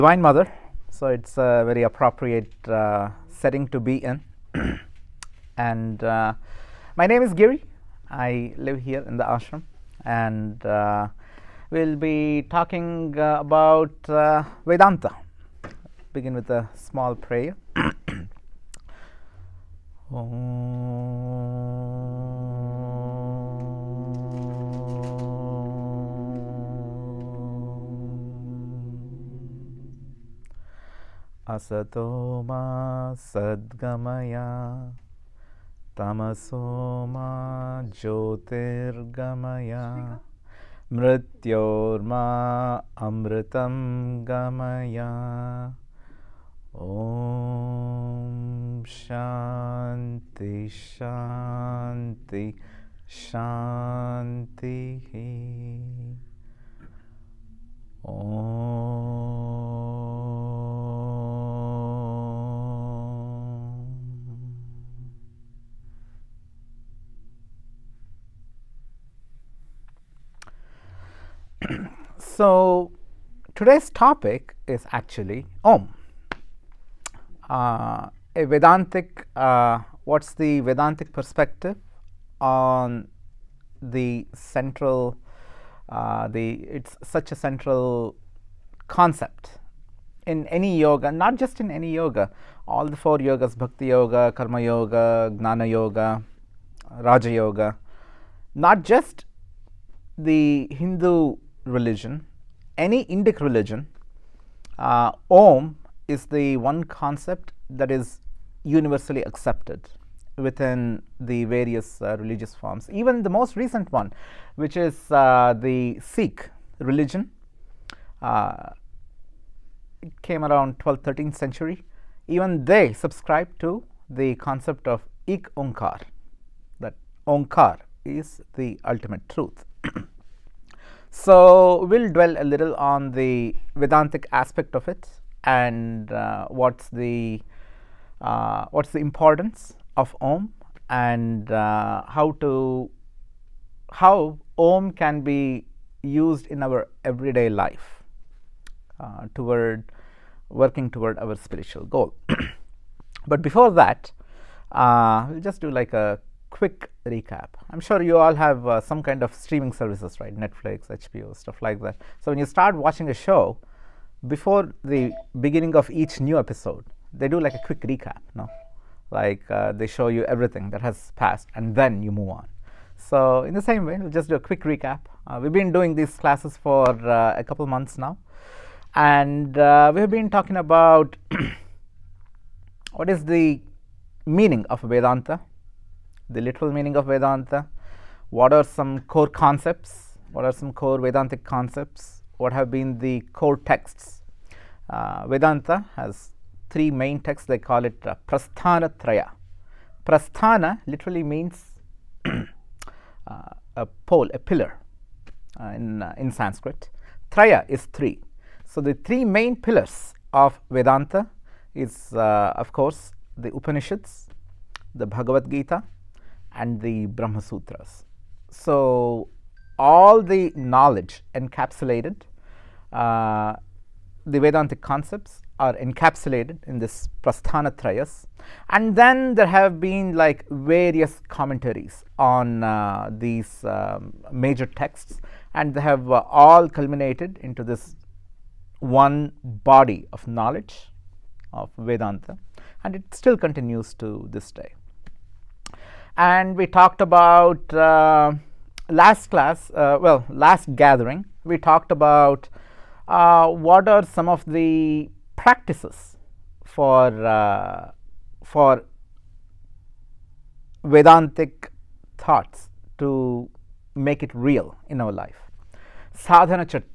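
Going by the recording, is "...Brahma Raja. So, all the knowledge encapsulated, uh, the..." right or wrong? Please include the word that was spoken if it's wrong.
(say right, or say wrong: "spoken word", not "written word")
wrong: "Sutras", not "Raja".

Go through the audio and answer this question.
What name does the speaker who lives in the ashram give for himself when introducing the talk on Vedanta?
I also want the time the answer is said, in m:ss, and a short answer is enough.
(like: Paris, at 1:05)
Giri, at 0:07.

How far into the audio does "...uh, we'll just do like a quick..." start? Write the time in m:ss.
2:34.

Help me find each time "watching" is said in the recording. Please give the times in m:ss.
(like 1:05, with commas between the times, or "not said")
2:42.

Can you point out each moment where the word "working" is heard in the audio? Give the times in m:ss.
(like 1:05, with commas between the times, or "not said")
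2:30.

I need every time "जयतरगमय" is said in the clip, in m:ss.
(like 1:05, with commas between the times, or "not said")
0:38.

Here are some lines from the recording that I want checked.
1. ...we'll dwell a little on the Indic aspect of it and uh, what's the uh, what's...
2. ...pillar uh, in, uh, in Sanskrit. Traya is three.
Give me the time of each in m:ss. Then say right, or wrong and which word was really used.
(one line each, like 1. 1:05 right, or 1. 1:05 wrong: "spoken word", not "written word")
1. 2:11 wrong: "Vedantic", not "Indic"
2. 3:24 right.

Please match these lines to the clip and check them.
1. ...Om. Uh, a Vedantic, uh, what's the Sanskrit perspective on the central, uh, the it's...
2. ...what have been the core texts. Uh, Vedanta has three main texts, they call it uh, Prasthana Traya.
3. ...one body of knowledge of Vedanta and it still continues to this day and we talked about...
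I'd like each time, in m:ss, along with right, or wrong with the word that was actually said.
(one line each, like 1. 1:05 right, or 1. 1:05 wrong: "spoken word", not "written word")
1. 1:15 wrong: "Vedantic", not "Sanskrit"
2. 3:12 right
3. 3:58 right.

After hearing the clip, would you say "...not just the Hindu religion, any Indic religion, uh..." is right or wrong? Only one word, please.
right.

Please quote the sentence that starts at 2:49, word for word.
Like uh, they show you everything that has passed, and then you move on.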